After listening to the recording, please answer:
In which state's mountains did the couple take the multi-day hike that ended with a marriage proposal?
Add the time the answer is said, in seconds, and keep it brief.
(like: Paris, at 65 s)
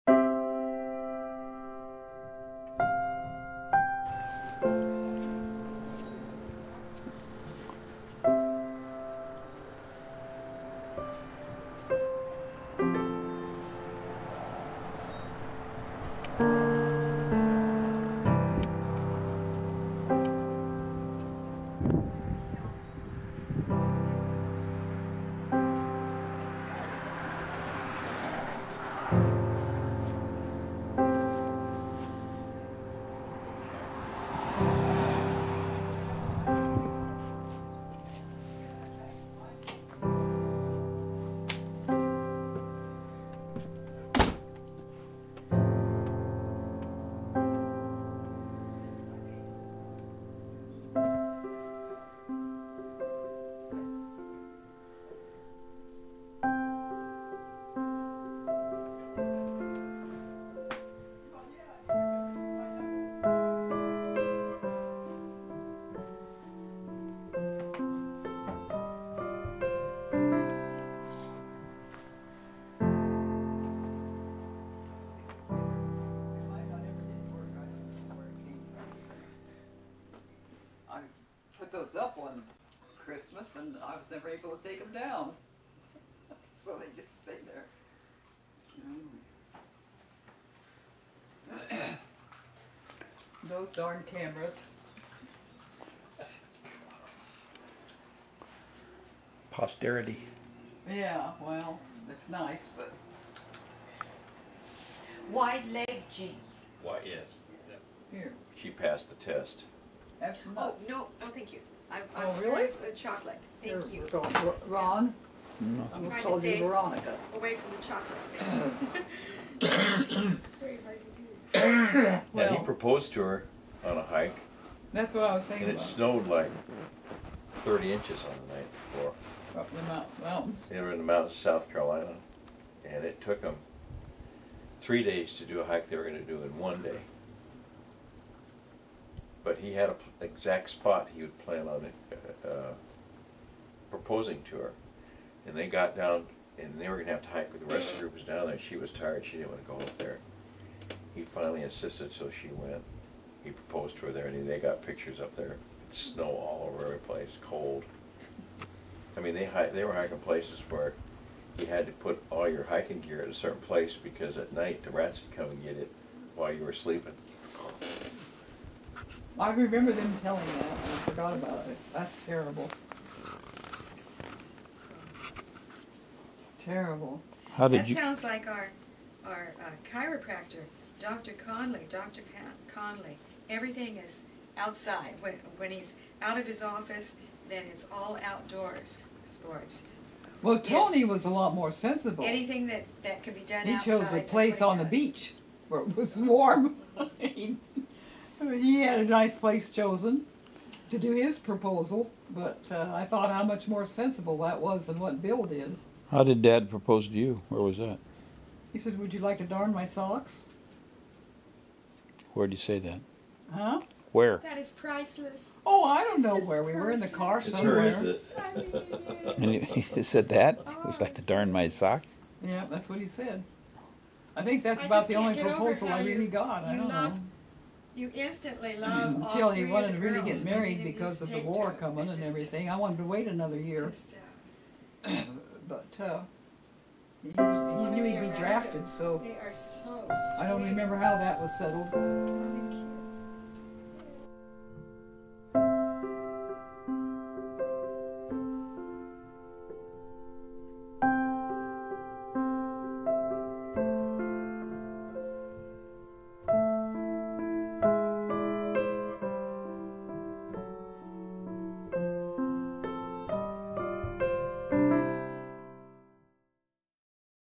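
South Carolina, at 131 s.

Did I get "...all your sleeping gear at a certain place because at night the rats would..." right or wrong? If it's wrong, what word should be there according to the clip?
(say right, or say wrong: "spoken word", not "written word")
wrong: "hiking", not "sleeping".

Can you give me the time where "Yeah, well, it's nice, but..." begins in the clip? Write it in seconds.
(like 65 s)
100 s.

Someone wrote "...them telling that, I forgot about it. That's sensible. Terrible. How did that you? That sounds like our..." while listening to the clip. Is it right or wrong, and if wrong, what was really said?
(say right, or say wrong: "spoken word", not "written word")
wrong: "terrible", not "sensible".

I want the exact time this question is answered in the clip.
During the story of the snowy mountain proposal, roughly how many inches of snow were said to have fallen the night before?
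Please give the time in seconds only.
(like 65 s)
127 s.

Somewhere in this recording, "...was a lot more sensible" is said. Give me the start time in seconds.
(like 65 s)
191 s.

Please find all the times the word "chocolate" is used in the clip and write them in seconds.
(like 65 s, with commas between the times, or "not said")
112 s, 119 s.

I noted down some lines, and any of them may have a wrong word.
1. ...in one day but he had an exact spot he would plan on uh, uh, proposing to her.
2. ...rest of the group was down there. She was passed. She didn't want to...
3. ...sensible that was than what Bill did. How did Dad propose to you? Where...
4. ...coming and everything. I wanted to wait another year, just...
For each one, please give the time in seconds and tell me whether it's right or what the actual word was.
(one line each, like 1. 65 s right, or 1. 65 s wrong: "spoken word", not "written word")
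1. 136 s right
2. 147 s wrong: "tired", not "passed"
3. 203 s right
4. 231 s right.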